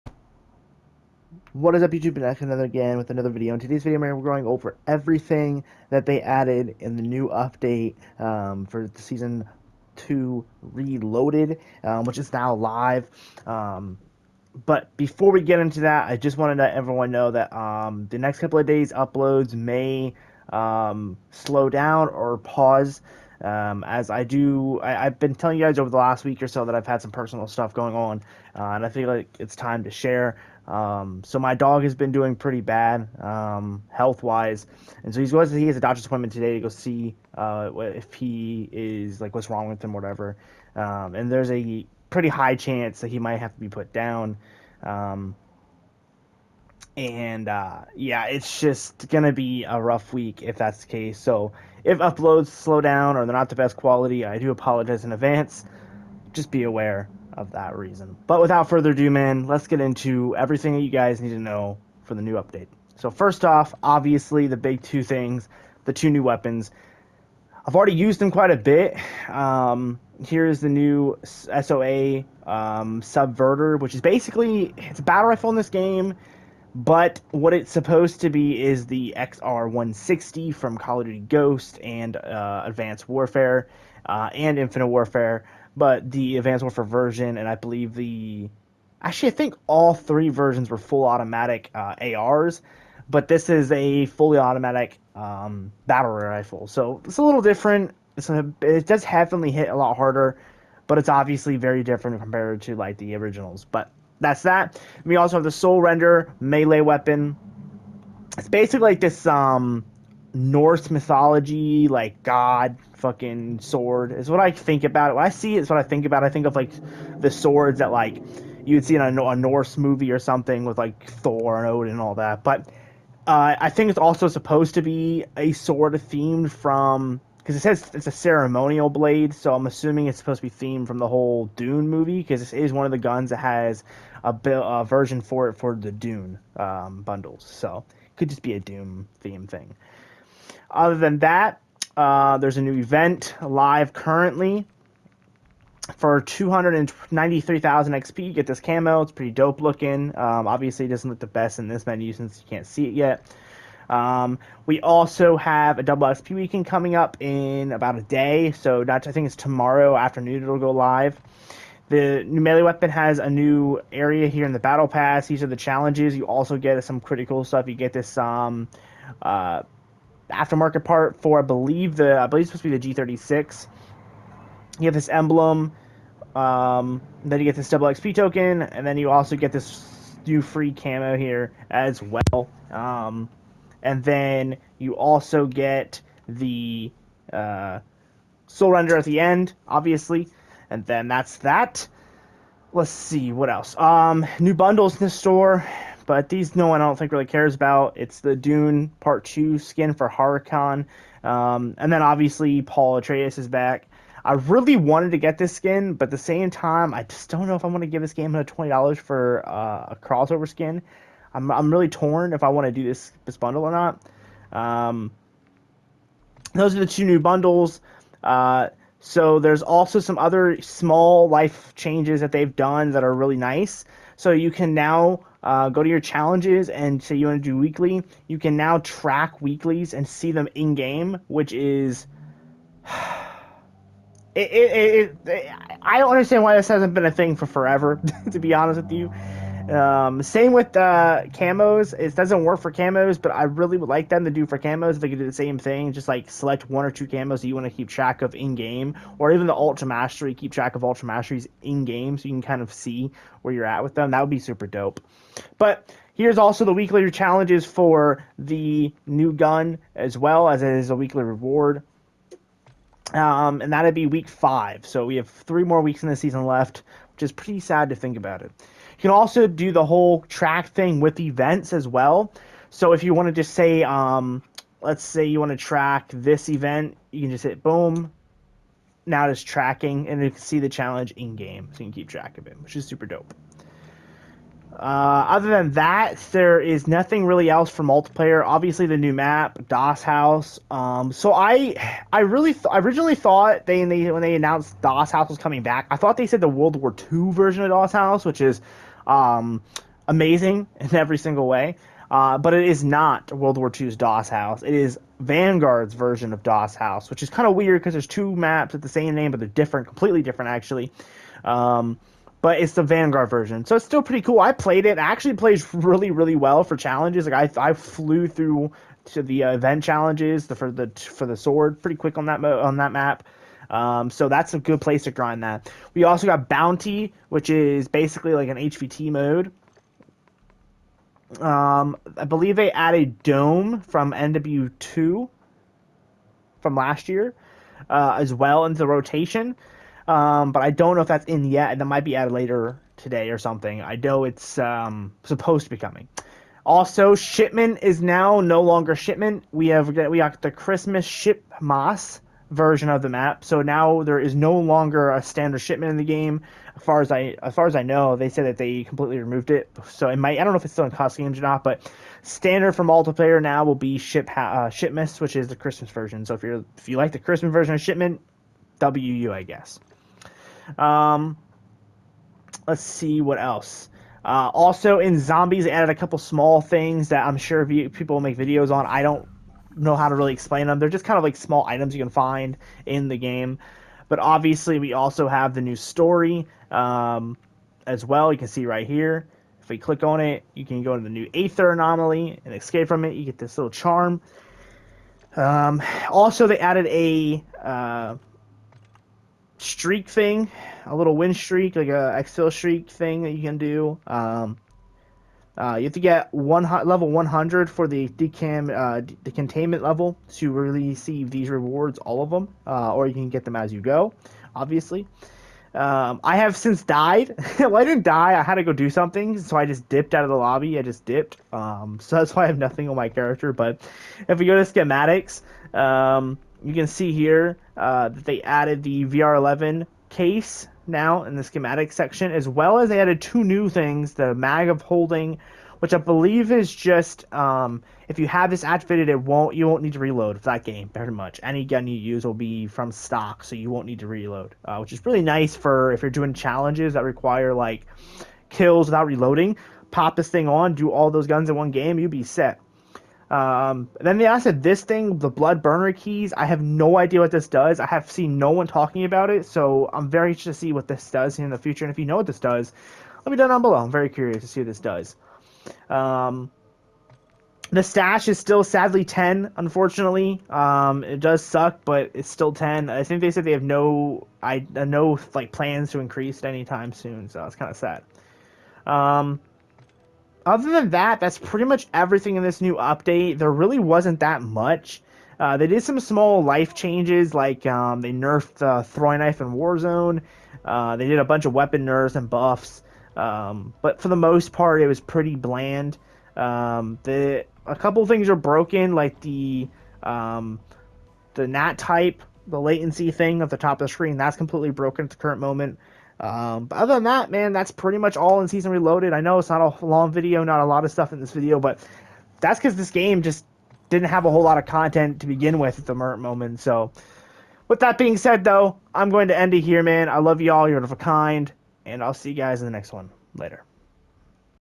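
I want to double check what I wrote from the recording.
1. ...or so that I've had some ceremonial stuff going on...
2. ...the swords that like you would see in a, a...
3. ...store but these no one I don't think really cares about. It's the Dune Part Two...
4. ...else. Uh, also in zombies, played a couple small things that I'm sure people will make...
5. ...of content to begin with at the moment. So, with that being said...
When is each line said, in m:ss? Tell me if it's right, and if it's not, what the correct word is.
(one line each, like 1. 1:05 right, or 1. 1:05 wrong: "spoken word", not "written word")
1. 0:26 wrong: "personal", not "ceremonial"
2. 1:57 right
3. 3:15 right
4. 6:13 wrong: "added", not "played"
5. 8:34 right.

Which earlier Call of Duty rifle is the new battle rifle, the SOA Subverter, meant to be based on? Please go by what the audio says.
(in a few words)
XR160.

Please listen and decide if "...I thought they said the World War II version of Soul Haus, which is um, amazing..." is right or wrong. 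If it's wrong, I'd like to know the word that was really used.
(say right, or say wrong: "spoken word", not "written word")
wrong: "Das", not "Soul".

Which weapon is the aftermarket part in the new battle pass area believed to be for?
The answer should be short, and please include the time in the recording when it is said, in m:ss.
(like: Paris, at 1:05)
G36, at 2:53.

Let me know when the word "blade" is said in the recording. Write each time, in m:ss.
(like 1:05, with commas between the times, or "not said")
2:08.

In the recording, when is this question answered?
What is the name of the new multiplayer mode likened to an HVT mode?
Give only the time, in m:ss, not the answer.
5:26.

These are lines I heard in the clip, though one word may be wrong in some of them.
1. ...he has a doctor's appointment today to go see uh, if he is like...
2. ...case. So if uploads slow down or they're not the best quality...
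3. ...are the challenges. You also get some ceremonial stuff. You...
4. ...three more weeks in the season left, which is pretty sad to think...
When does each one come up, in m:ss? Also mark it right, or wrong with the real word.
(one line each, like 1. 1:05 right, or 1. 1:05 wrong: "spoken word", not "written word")
1. 0:35 right
2. 0:50 right
3. 2:45 wrong: "critical", not "ceremonial"
4. 4:25 right.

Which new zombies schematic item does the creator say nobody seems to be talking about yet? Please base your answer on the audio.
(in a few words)
Blood Burner keys.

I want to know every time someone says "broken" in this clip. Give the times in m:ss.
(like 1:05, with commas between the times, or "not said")
8:18, 8:24.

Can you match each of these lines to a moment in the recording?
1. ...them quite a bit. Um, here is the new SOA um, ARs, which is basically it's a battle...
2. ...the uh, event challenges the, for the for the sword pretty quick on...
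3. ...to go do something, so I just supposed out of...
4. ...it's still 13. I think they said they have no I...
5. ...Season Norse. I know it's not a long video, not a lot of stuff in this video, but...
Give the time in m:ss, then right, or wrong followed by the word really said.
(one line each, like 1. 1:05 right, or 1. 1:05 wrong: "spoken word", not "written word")
1. 1:08 wrong: "Subverter", not "ARs"
2. 5:19 right
3. 6:58 wrong: "dipped", not "supposed"
4. 7:52 wrong: "10", not "13"
5. 8:28 wrong: "Reloaded", not "Norse".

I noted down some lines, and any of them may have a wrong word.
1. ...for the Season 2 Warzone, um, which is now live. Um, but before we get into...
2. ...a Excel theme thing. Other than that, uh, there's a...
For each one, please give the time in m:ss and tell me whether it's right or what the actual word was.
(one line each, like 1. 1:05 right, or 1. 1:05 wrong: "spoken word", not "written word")
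1. 0:08 wrong: "Reloaded", not "Warzone"
2. 2:18 wrong: "Dune", not "Excel".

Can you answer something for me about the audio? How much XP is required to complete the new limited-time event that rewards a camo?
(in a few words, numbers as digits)
293,000.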